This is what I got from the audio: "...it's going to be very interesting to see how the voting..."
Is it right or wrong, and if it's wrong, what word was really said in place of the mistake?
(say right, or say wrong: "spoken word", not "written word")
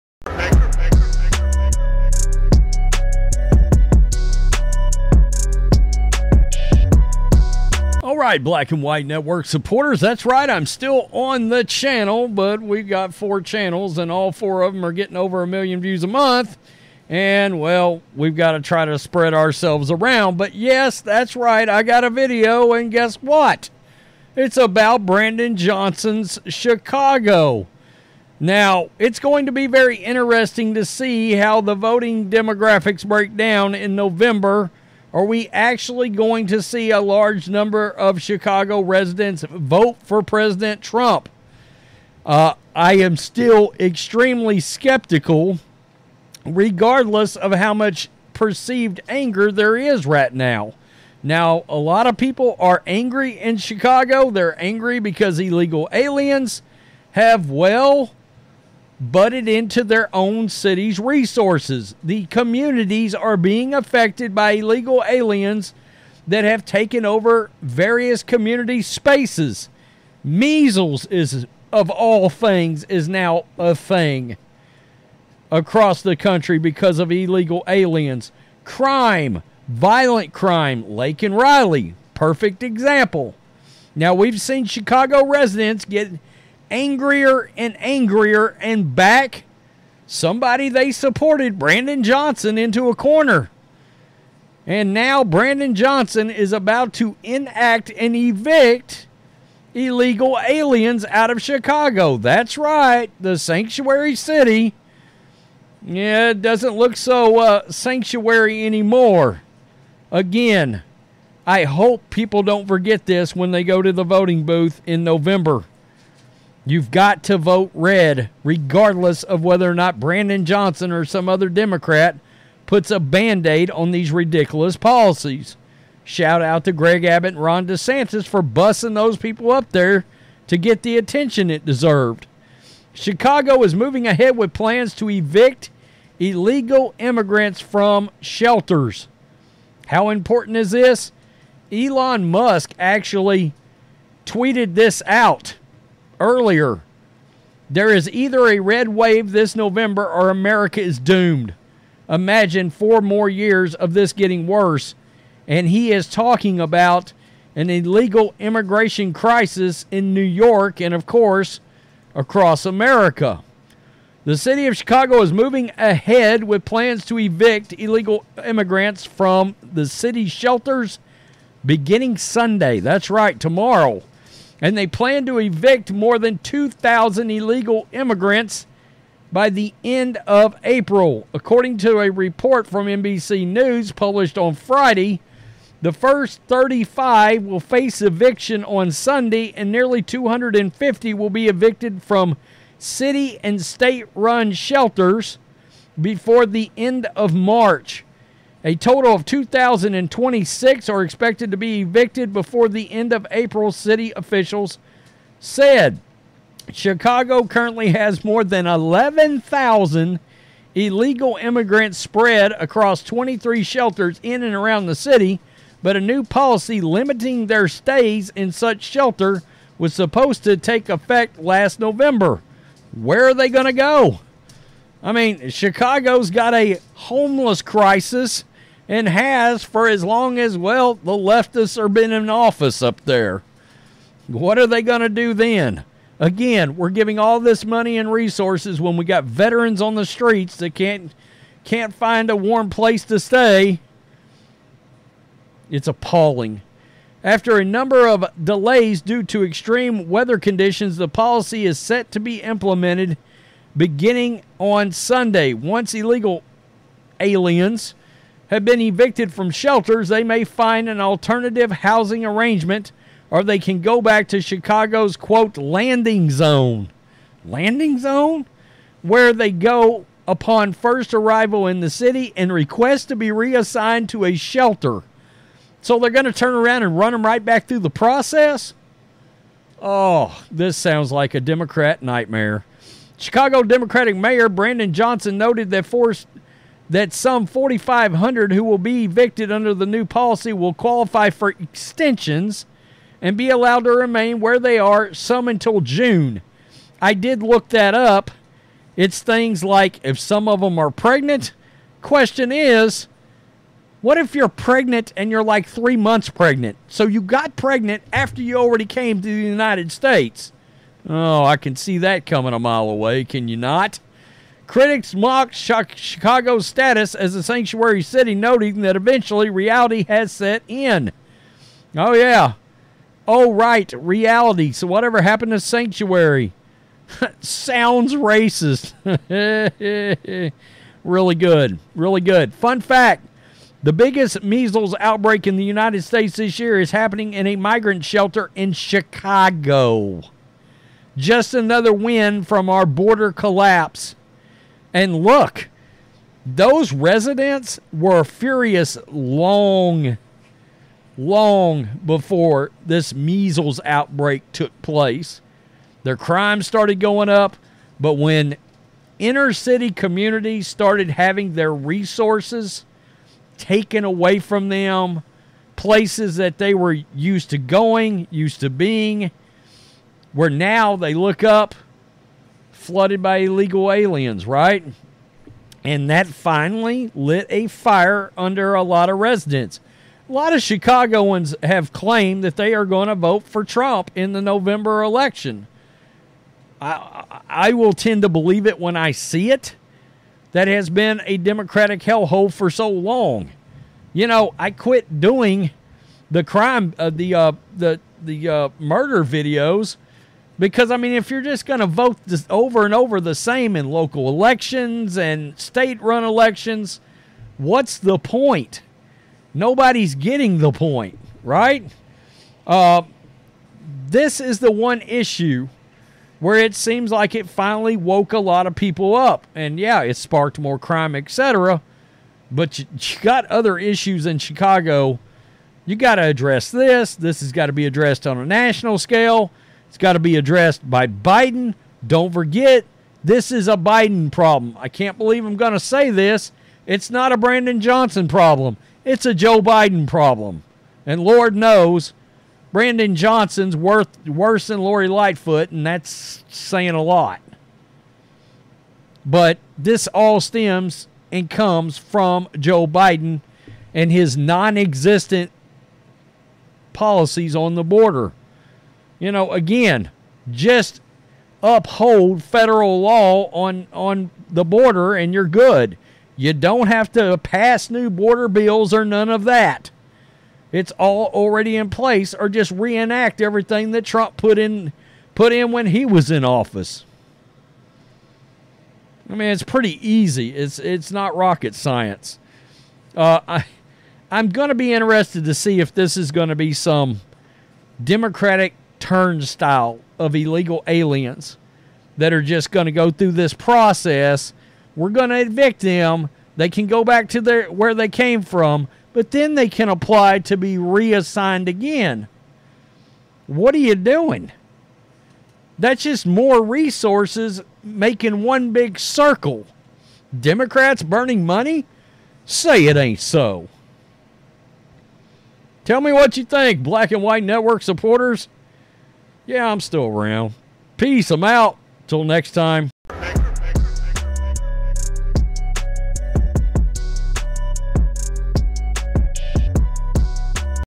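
right.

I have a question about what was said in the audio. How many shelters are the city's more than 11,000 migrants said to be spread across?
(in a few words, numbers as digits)
23.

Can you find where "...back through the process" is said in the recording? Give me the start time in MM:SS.
04:37.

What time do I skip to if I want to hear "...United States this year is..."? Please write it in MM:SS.
05:35.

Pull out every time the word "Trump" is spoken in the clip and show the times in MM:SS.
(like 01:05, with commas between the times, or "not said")
00:40, 06:23, 07:54.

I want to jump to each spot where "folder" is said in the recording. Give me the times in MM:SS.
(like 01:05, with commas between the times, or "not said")
not said.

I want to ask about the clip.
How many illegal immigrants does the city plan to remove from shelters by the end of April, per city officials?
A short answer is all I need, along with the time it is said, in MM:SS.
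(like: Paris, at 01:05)
2,026, at 03:19.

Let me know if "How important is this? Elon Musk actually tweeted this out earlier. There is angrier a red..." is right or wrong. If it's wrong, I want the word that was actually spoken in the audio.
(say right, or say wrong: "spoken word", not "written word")
wrong: "either", not "angrier".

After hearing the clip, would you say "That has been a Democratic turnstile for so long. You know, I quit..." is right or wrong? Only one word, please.
wrong.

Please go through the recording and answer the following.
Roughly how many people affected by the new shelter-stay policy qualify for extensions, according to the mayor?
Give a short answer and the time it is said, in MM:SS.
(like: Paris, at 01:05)
4,500, at 04:47.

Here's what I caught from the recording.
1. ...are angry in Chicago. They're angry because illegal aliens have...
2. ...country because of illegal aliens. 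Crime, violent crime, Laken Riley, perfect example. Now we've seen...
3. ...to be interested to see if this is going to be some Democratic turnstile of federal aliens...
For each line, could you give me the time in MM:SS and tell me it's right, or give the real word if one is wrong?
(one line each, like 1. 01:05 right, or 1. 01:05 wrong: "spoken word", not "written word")
1. 00:52 right
2. 01:16 right
3. 08:04 wrong: "illegal", not "federal".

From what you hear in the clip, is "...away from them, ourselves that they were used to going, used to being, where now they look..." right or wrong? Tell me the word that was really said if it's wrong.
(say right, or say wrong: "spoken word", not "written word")
wrong: "places", not "ourselves".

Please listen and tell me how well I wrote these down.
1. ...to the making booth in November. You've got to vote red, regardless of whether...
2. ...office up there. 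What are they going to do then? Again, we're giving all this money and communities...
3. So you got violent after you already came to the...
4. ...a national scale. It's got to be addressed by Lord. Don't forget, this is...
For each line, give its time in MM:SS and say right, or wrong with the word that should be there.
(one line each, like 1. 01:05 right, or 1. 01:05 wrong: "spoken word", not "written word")
1. 01:53 wrong: "voting", not "making"
2. 03:52 wrong: "resources", not "communities"
3. 05:06 wrong: "pregnant", not "violent"
4. 07:08 wrong: "Biden", not "Lord".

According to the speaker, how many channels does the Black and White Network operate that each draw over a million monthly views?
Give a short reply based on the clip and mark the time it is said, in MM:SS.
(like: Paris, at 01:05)
4, at 00:13.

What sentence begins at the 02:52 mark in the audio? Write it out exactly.
That's right, tomorrow and they plan to evict more than 2,000 illegal immigrants by the end of April.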